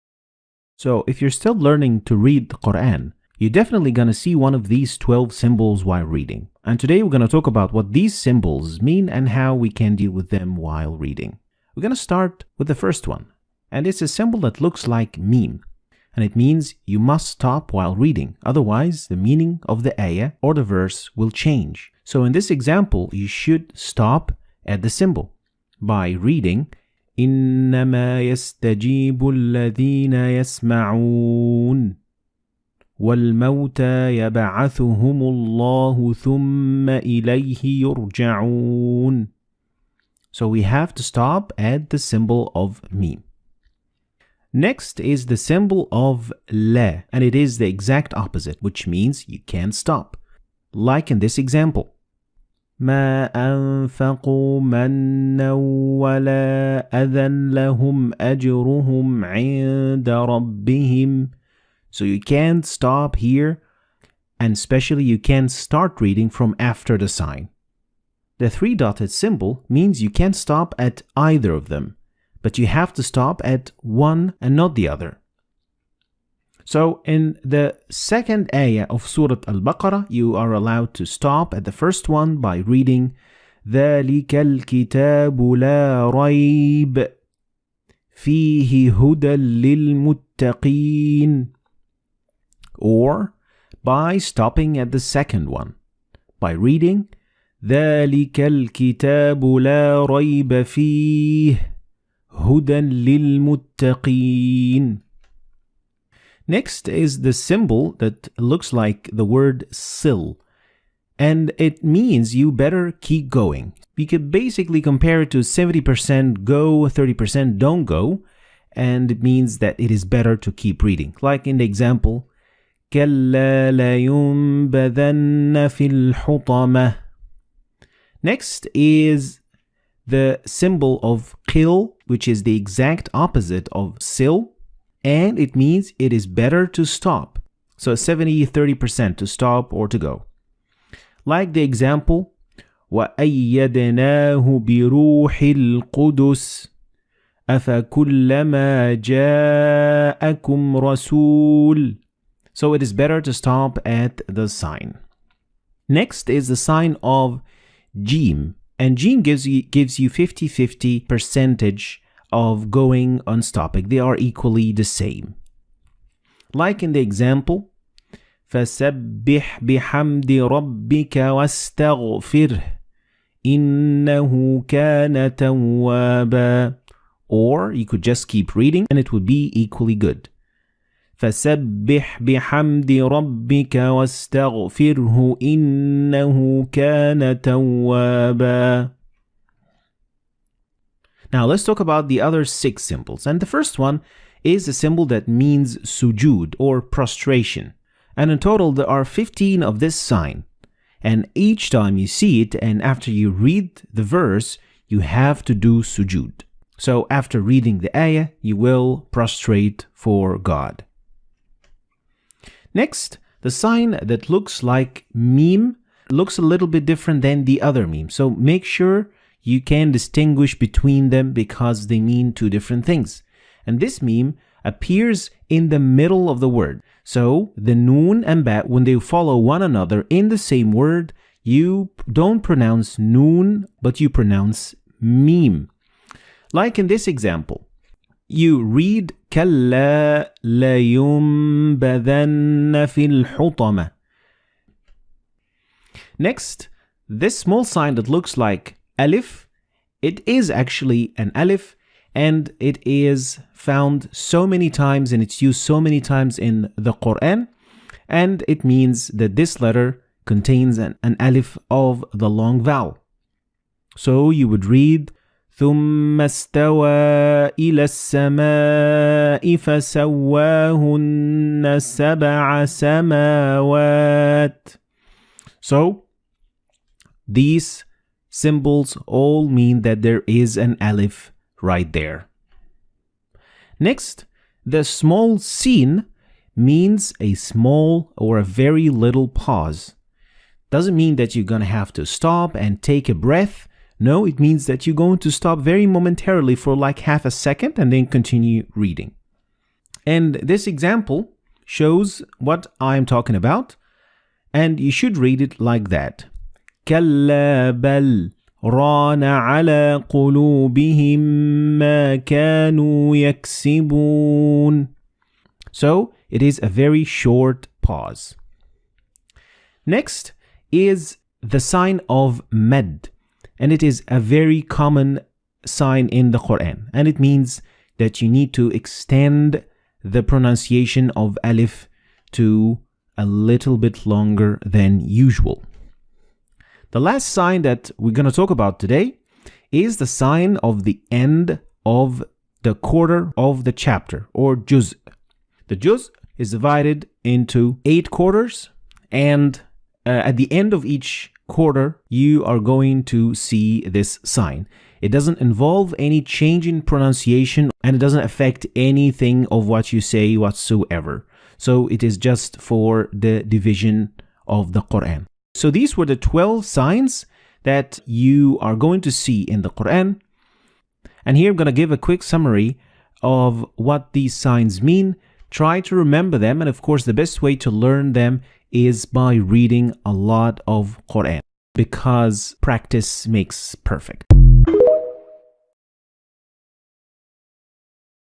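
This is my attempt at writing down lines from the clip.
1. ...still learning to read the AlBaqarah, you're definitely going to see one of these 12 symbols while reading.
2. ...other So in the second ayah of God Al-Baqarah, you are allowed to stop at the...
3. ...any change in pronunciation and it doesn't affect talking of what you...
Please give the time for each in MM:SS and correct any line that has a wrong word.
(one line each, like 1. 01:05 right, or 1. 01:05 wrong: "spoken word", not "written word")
1. 00:01 wrong: "Quran", not "AlBaqarah"
2. 01:14 wrong: "Surah", not "God"
3. 05:55 wrong: "anything", not "talking".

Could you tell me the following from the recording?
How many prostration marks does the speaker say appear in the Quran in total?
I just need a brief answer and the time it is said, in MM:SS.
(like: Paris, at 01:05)
15, at 03:19.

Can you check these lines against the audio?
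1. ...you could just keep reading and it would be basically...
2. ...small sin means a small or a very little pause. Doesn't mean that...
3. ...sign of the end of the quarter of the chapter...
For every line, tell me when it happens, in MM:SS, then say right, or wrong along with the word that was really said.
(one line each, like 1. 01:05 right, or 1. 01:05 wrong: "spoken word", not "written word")
1. 02:57 wrong: "equally", not "basically"
2. 04:44 right
3. 05:40 right.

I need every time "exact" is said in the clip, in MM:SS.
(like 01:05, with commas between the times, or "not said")
00:47, 02:12.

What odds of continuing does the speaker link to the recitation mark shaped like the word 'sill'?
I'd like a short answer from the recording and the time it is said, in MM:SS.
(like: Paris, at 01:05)
70% go, 30% don't go, at 01:55.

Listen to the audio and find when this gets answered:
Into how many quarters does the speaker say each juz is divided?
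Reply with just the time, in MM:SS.
05:47.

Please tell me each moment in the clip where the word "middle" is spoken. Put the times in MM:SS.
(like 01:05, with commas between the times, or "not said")
03:45.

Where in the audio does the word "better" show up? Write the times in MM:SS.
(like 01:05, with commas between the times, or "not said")
01:52, 02:00, 02:16, 02:32.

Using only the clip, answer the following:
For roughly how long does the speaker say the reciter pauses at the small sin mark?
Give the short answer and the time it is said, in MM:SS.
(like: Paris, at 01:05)
half a second, at 04:56.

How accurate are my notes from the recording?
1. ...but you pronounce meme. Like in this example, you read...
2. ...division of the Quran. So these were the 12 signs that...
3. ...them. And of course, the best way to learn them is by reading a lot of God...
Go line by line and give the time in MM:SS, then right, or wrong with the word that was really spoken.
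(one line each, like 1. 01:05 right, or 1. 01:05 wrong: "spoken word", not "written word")
1. 03:53 right
2. 06:03 right
3. 06:16 wrong: "Quran", not "God".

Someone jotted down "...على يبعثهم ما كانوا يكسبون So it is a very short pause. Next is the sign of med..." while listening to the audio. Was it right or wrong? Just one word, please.
wrong.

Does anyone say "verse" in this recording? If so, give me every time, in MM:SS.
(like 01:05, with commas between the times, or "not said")
00:20, 03:24.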